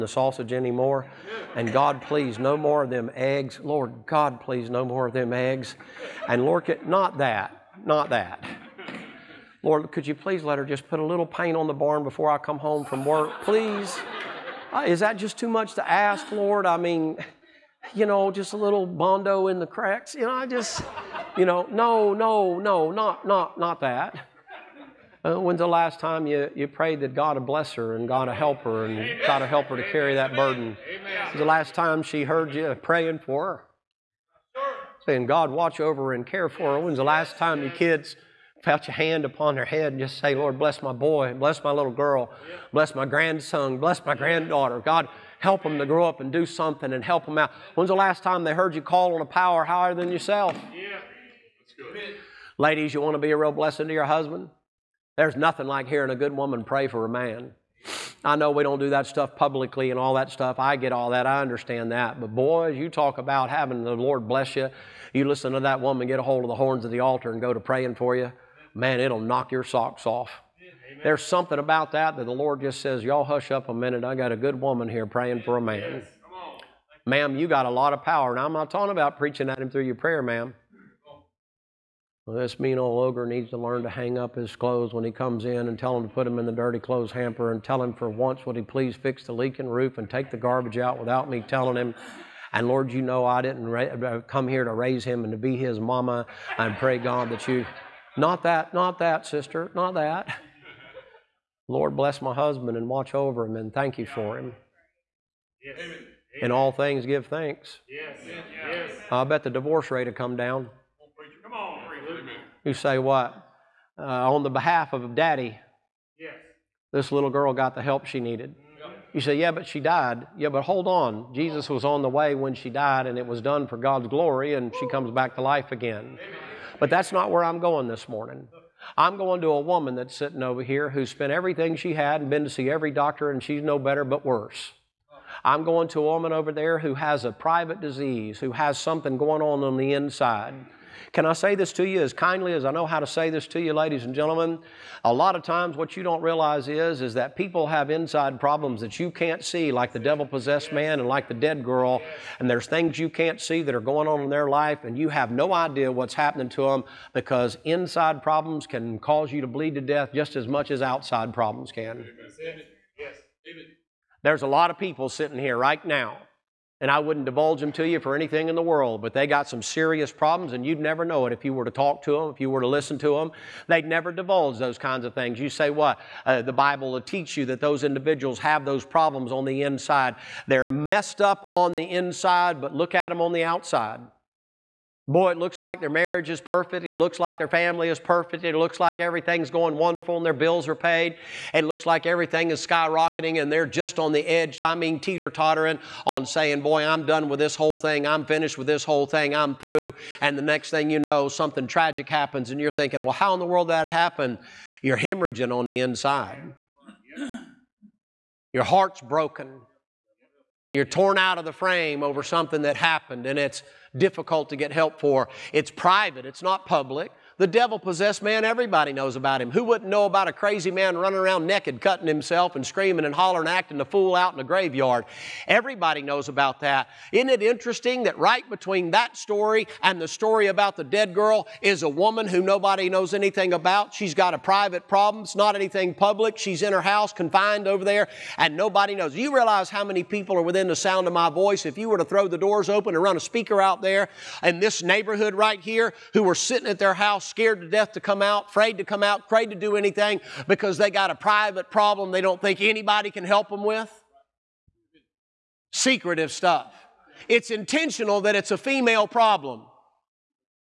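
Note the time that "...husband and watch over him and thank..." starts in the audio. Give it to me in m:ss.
1:42.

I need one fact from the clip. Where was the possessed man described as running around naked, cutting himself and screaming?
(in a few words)
the graveyard.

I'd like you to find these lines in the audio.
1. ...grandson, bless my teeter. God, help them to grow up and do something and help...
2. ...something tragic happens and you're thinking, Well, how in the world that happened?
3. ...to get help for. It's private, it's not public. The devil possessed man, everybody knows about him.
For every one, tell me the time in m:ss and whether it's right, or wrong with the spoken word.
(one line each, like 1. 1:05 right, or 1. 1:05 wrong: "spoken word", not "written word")
1. 0:43 wrong: "granddaughter", not "teeter"
2. 3:21 right
3. 3:34 right.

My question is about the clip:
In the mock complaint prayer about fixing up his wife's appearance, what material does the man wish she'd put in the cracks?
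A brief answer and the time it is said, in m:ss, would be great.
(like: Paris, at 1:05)
bondo, at 0:18.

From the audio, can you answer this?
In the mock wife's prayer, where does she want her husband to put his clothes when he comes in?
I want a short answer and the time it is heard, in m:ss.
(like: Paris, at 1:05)
dirty clothes hamper, at 1:26.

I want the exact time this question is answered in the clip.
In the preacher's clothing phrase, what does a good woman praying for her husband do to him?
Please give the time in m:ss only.
1:09.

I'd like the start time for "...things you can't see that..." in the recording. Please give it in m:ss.
2:32.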